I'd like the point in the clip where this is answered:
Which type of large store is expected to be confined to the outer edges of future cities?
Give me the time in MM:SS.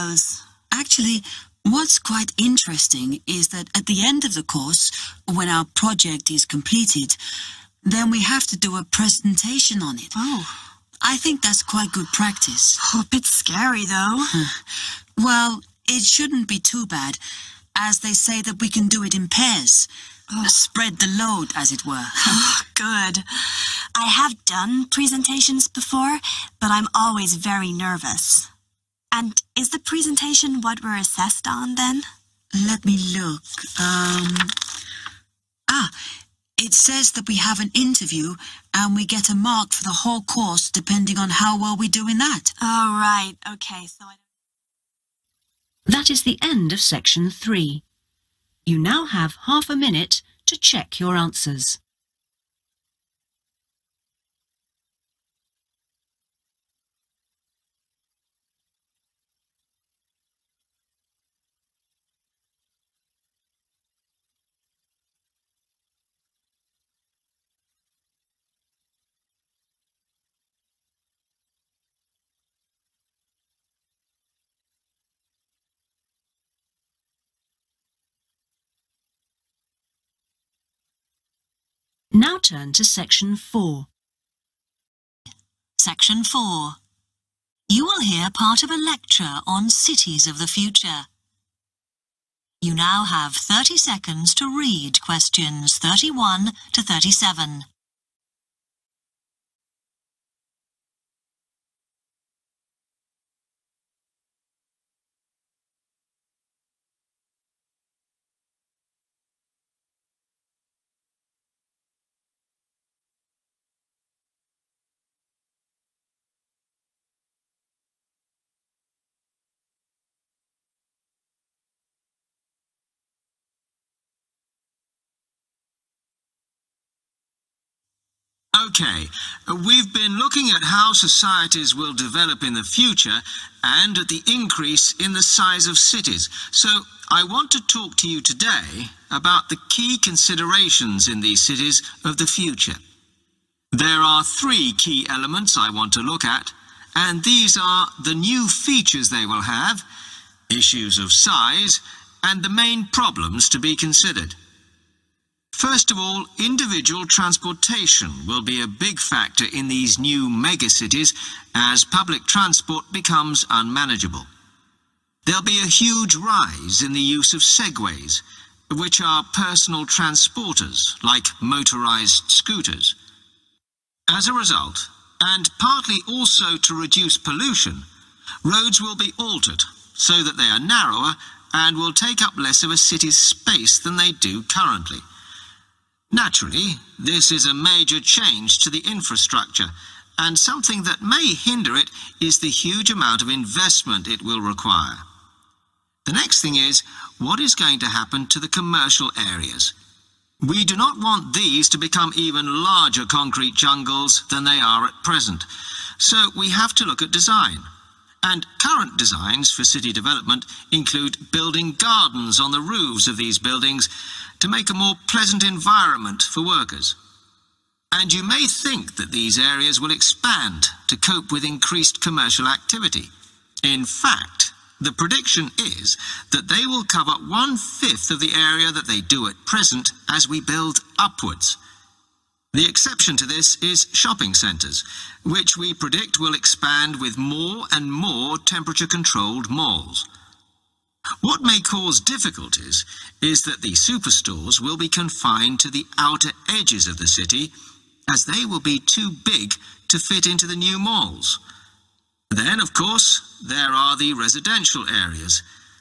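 04:03.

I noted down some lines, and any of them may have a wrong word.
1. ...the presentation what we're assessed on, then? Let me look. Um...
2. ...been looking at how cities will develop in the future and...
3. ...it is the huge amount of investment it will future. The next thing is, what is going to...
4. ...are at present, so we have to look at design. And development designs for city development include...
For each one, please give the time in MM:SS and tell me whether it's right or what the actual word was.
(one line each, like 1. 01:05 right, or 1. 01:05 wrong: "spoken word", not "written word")
1. 00:29 right
2. 02:09 wrong: "societies", not "cities"
3. 03:11 wrong: "require", not "future"
4. 03:24 wrong: "current", not "development".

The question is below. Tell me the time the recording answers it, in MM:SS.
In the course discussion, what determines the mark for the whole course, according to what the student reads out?
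00:37.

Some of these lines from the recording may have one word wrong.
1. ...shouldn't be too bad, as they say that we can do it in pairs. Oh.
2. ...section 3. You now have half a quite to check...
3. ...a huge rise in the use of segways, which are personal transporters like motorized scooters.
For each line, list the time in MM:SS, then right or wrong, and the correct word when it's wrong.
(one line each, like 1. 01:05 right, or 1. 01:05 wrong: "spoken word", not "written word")
1. 00:16 right
2. 00:46 wrong: "minute", not "quite"
3. 02:45 right.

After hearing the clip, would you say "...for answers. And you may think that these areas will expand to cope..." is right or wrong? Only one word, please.
wrong.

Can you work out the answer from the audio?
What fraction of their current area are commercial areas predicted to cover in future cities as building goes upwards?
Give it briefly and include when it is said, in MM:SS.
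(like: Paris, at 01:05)
one-fifth, at 03:47.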